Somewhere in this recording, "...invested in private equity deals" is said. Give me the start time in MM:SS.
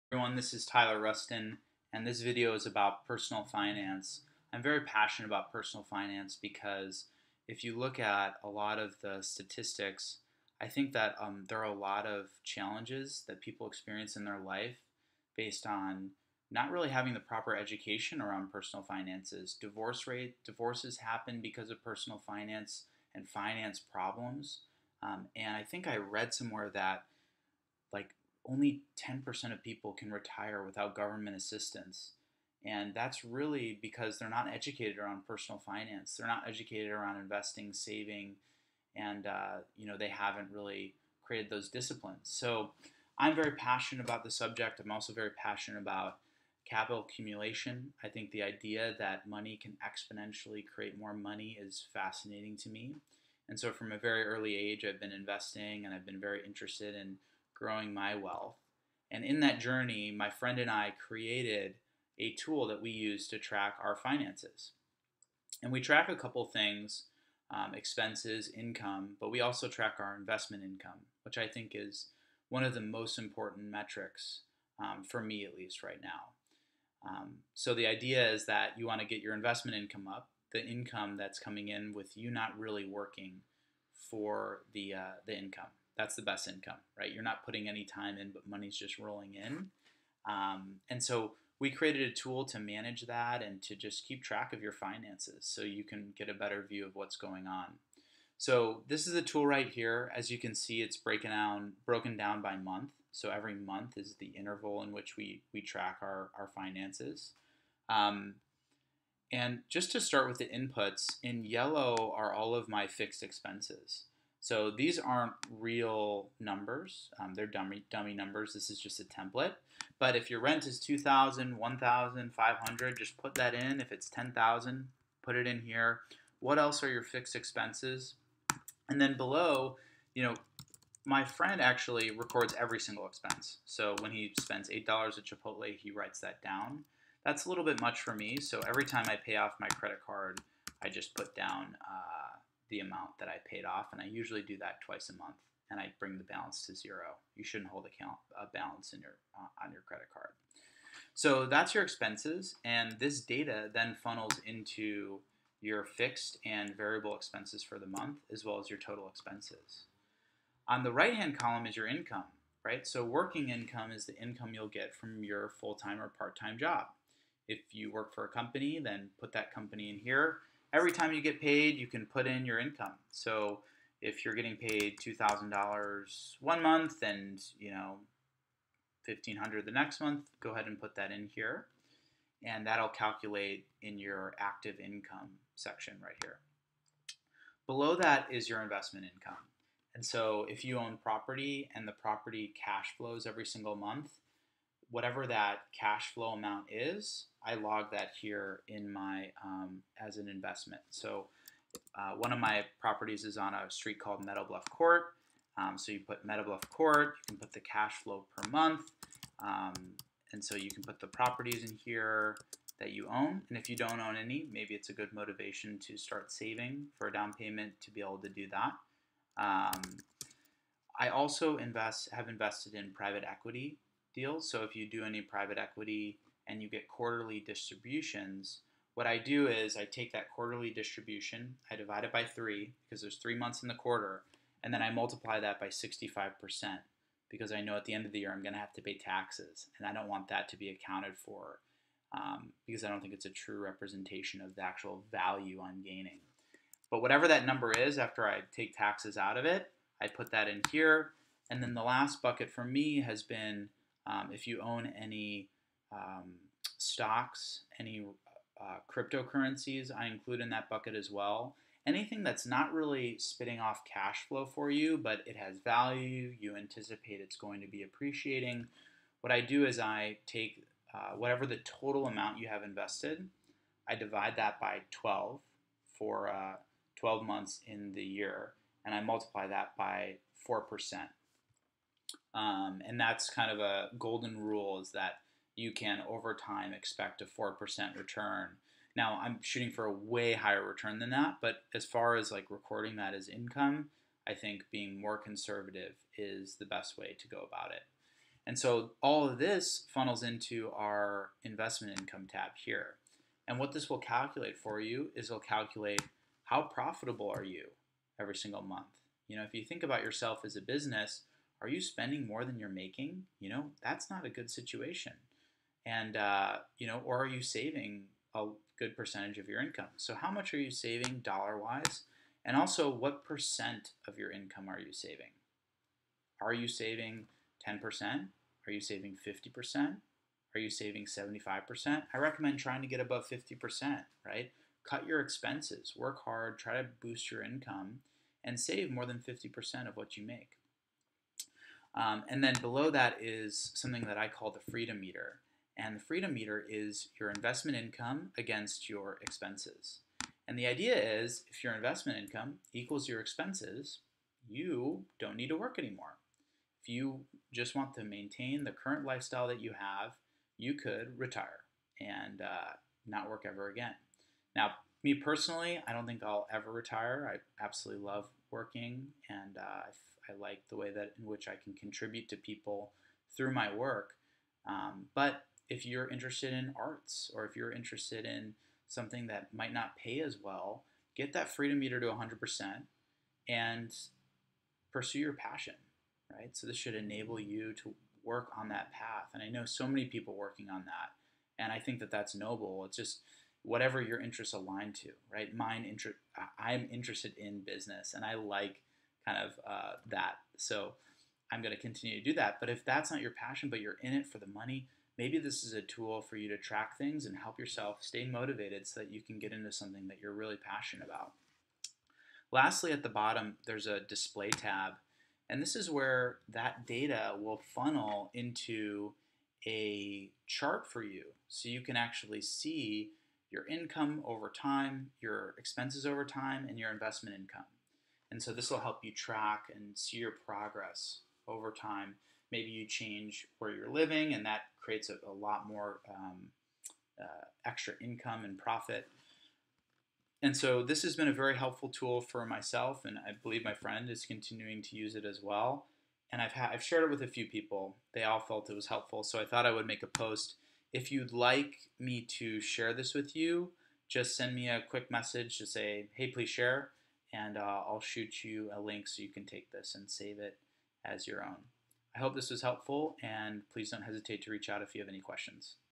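03:42.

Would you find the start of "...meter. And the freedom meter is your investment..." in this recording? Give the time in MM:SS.
05:45.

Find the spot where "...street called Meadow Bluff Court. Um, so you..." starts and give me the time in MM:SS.
03:23.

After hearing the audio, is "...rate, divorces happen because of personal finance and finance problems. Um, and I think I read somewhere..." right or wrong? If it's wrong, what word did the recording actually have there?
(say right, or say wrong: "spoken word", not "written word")
right.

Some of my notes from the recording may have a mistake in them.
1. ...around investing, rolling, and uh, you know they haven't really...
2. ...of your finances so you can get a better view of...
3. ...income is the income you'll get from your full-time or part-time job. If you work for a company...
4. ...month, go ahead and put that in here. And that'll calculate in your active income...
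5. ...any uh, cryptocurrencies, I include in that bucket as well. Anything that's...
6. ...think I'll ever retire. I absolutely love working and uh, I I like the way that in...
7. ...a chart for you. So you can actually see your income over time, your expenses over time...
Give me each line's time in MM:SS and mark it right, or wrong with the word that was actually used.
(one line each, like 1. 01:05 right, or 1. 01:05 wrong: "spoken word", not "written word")
1. 00:36 wrong: "saving", not "rolling"
2. 01:34 right
3. 02:43 right
4. 03:00 right
5. 04:17 right
6. 06:06 right
7. 06:59 right.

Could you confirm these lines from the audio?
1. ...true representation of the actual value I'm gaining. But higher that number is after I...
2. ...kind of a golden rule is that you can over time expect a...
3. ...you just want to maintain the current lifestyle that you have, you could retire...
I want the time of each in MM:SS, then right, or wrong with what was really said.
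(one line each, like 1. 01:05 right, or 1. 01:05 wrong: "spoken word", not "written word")
1. 04:03 wrong: "whatever", not "higher"
2. 04:43 right
3. 05:56 right.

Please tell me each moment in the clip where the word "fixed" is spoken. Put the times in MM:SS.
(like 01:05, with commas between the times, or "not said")
01:52, 02:07, 02:35.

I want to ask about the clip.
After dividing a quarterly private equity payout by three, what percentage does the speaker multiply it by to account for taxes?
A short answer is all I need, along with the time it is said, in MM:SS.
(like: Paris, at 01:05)
65%, at 03:55.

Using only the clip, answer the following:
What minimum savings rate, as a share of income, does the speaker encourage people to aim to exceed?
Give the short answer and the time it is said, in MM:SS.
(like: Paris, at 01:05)
50%, at 05:32.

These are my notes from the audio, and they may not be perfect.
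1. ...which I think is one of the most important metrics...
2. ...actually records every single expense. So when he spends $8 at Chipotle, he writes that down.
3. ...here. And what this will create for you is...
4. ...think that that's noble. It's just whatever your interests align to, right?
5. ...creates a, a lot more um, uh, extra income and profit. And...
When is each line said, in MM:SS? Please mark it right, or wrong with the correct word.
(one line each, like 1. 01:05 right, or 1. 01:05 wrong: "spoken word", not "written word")
1. 01:11 right
2. 02:11 right
3. 05:02 wrong: "calculate", not "create"
4. 06:31 right
5. 07:14 right.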